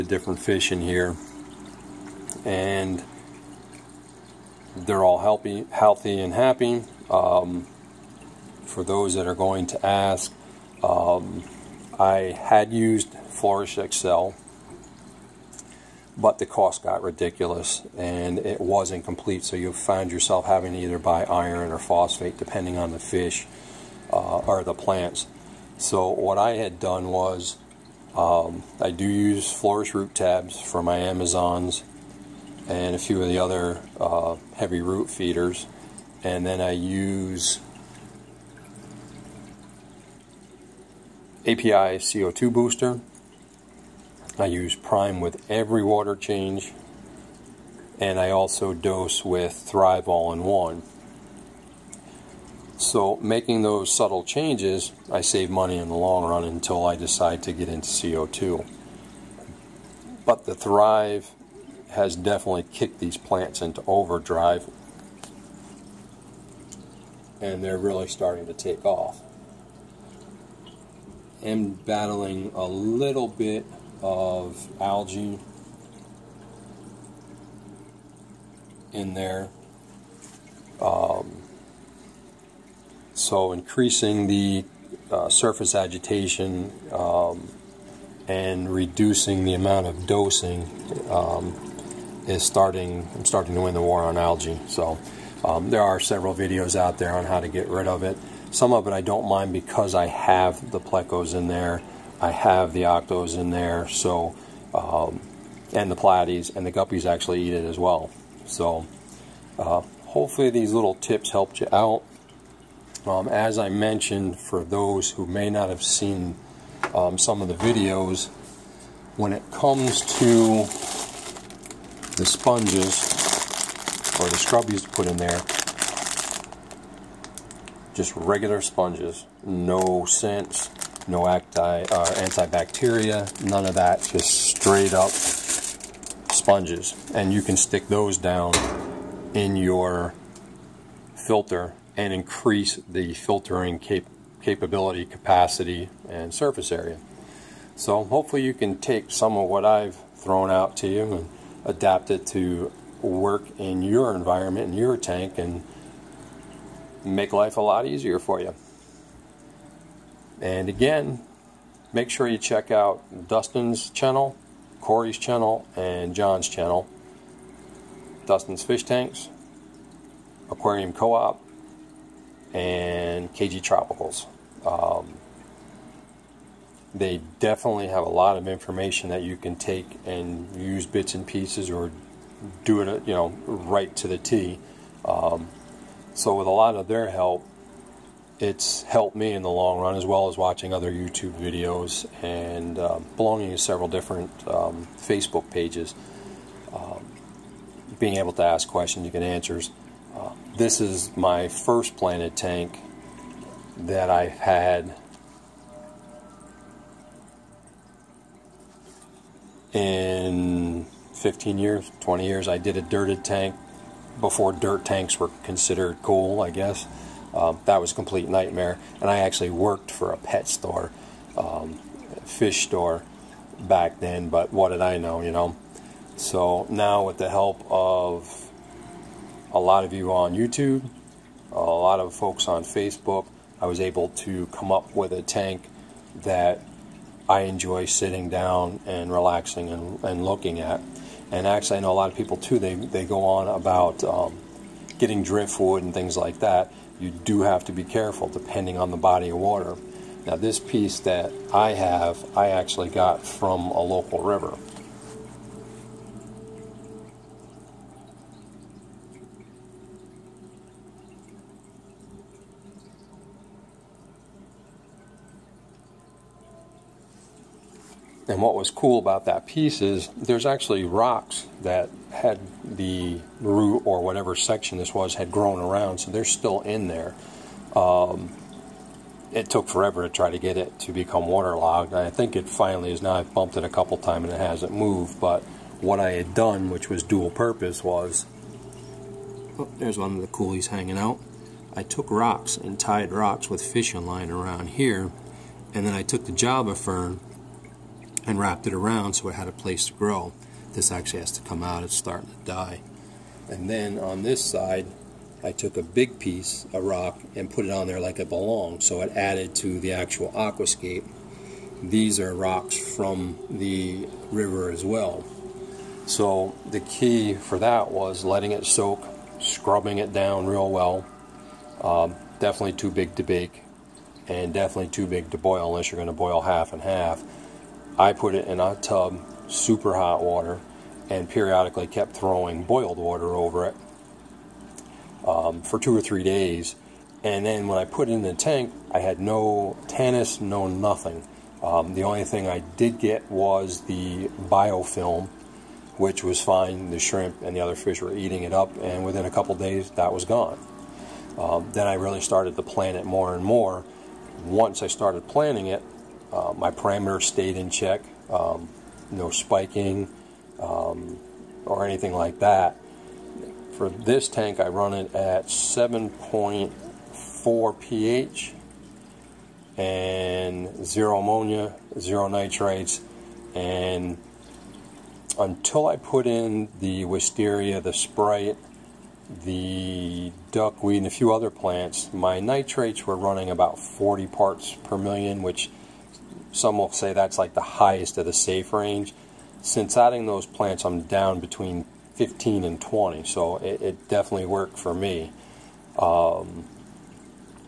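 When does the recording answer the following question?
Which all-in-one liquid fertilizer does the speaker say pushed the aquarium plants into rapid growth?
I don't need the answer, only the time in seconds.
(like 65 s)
49 s.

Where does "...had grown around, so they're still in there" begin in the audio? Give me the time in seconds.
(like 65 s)
275 s.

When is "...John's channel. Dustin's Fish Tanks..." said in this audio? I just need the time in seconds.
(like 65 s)
166 s.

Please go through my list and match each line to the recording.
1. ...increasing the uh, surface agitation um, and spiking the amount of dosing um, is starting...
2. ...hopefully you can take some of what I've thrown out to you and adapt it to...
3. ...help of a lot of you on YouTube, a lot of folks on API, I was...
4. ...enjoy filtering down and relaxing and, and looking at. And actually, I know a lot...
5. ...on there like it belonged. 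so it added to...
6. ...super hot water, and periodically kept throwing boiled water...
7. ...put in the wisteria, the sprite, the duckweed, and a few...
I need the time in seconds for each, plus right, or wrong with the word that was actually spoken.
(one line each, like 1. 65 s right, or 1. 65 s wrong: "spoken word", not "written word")
1. 83 s wrong: "reducing", not "spiking"
2. 148 s right
3. 227 s wrong: "Facebook", not "API"
4. 237 s wrong: "sitting", not "filtering"
5. 307 s right
6. 329 s right
7. 375 s right.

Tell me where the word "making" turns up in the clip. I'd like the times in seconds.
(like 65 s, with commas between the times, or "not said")
53 s.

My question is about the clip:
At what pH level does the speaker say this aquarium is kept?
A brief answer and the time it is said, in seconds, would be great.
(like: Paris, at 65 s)
7.4, at 365 s.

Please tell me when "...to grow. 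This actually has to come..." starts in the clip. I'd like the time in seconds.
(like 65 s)
299 s.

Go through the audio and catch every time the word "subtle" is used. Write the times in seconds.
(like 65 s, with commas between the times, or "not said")
53 s.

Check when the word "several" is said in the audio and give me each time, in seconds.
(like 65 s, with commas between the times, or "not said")
95 s, 193 s.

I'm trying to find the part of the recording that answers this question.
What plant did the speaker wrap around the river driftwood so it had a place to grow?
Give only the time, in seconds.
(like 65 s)
296 s.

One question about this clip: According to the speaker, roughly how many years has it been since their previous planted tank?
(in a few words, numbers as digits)
15 to 20 years.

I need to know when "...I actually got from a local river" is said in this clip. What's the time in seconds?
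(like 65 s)
252 s.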